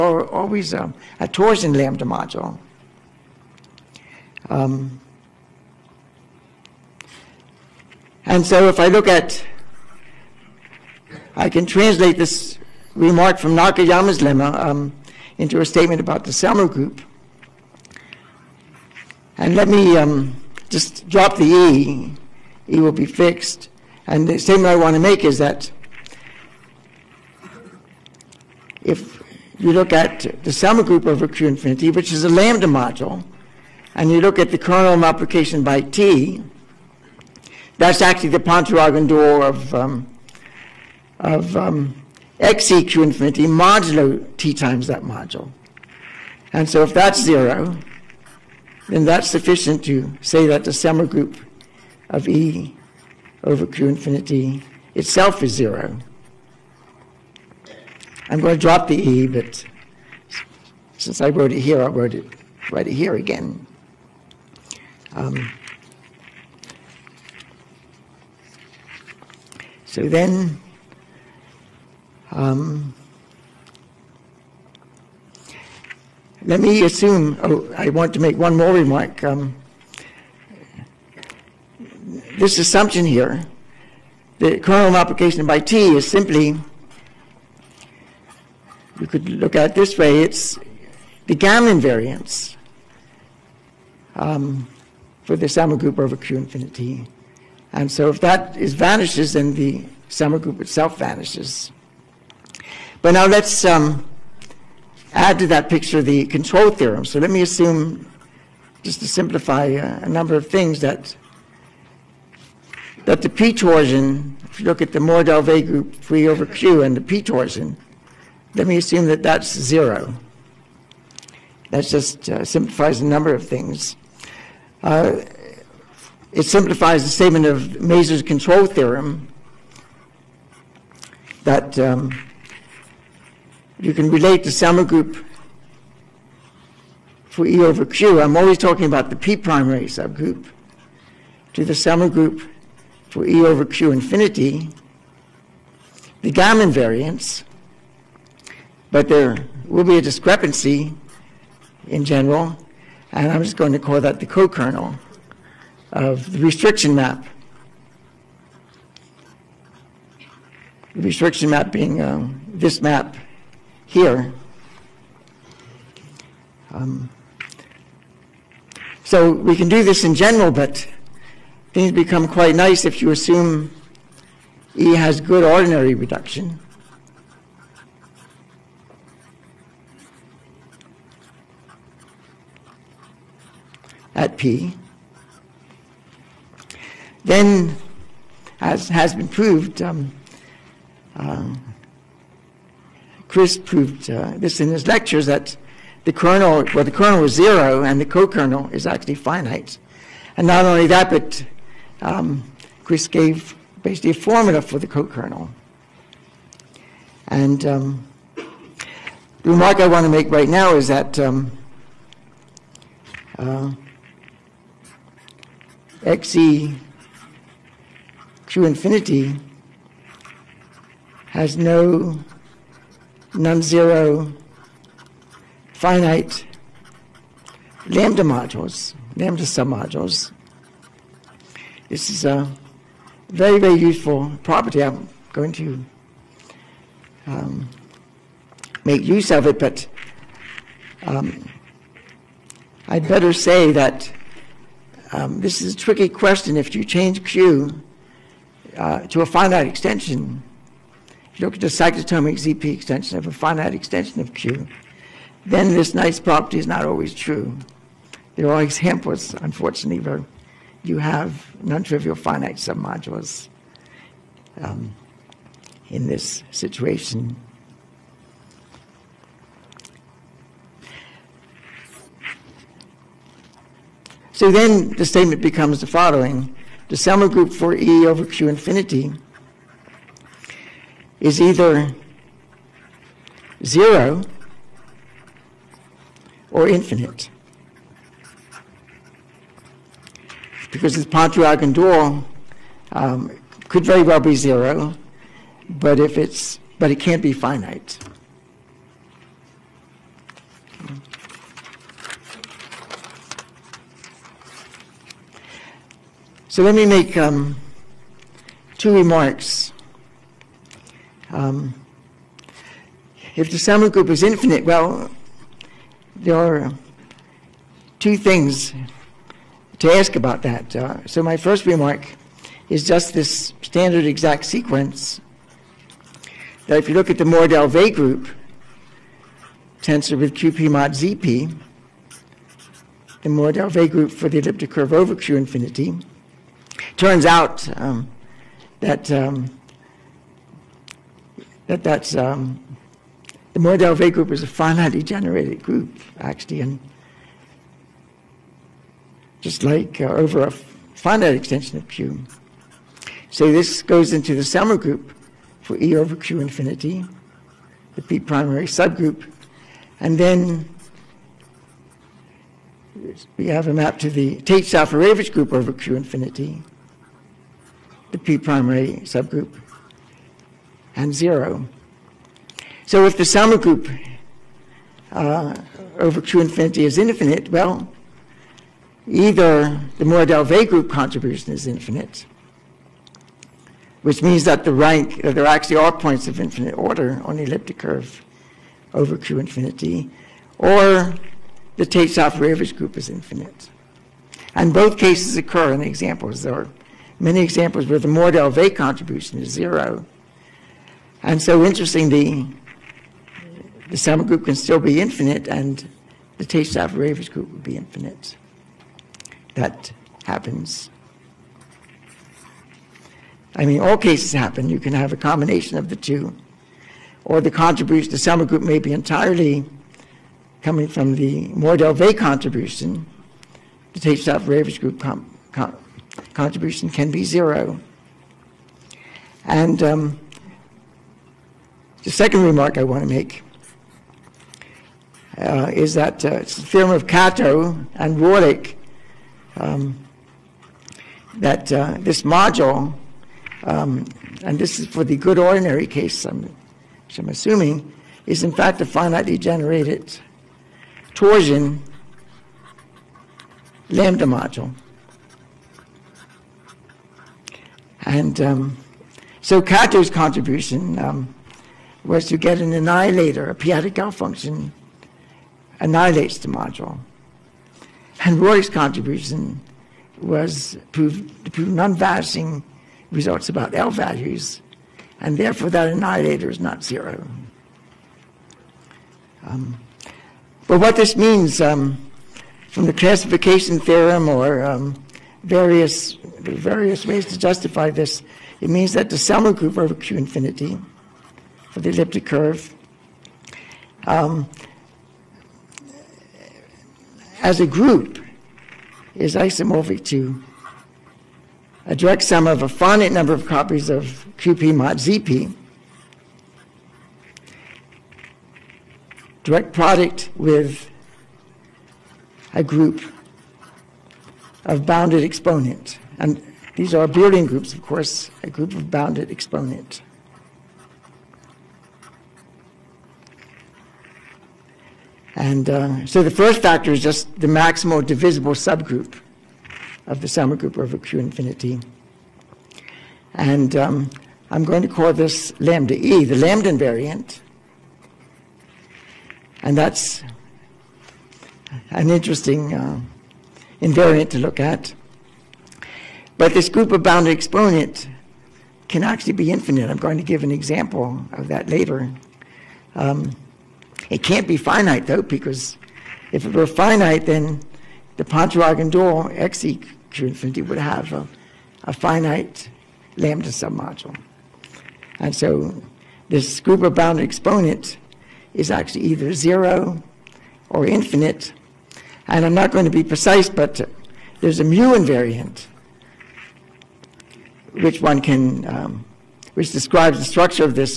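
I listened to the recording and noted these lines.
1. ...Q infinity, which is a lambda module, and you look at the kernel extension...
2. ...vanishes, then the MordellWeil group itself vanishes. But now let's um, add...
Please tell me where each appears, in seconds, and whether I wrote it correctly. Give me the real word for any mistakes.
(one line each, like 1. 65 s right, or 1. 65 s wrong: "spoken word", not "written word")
1. 31 s wrong: "multiplication", not "extension"
2. 98 s wrong: "Selmer", not "MordellWeil".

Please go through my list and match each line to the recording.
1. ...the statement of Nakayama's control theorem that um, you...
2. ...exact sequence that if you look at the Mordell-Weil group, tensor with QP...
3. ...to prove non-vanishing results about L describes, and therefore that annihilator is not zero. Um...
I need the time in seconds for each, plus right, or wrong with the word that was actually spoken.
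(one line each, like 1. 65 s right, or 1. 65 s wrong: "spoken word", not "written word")
1. 127 s wrong: "Mazur", not "Nakayama"
2. 324 s right
3. 470 s wrong: "values", not "describes".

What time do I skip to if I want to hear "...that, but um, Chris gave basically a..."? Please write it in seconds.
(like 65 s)
200 s.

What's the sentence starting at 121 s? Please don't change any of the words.
That just uh, simplifies a number of things.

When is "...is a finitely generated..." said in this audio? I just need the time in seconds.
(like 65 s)
344 s.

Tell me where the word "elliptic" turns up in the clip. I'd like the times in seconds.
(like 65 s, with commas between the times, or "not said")
334 s, 387 s, 491 s.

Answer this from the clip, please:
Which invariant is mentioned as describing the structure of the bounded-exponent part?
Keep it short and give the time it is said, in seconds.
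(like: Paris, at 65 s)
mu invariant, at 574 s.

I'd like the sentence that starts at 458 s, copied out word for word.
And um, so Kato's contribution um, was to get an annihilator.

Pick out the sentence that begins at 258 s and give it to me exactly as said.
There are examples, unfortunately, where you have non-trivial finite submodules um, in this situation.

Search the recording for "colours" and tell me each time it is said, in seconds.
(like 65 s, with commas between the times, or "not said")
not said.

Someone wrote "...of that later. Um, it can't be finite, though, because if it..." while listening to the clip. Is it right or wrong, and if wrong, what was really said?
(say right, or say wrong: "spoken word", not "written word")
right.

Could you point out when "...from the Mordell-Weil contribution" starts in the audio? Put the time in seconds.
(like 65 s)
420 s.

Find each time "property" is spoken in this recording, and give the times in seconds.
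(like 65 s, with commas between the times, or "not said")
234 s, 256 s.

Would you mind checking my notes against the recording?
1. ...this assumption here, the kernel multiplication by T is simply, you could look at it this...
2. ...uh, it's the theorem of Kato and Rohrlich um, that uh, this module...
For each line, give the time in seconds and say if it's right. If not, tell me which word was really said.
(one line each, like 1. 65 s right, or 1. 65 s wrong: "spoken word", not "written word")
1. 82 s right
2. 436 s right.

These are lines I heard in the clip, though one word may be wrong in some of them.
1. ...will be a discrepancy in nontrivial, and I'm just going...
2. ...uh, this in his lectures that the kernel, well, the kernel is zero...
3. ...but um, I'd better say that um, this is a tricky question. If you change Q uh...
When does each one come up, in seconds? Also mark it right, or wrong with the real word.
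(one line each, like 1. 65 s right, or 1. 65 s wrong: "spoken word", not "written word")
1. 149 s wrong: "general", not "nontrivial"
2. 194 s right
3. 239 s right.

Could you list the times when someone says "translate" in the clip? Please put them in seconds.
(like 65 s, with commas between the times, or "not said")
11 s.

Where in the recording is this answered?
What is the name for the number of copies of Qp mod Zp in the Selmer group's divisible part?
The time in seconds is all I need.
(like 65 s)
536 s.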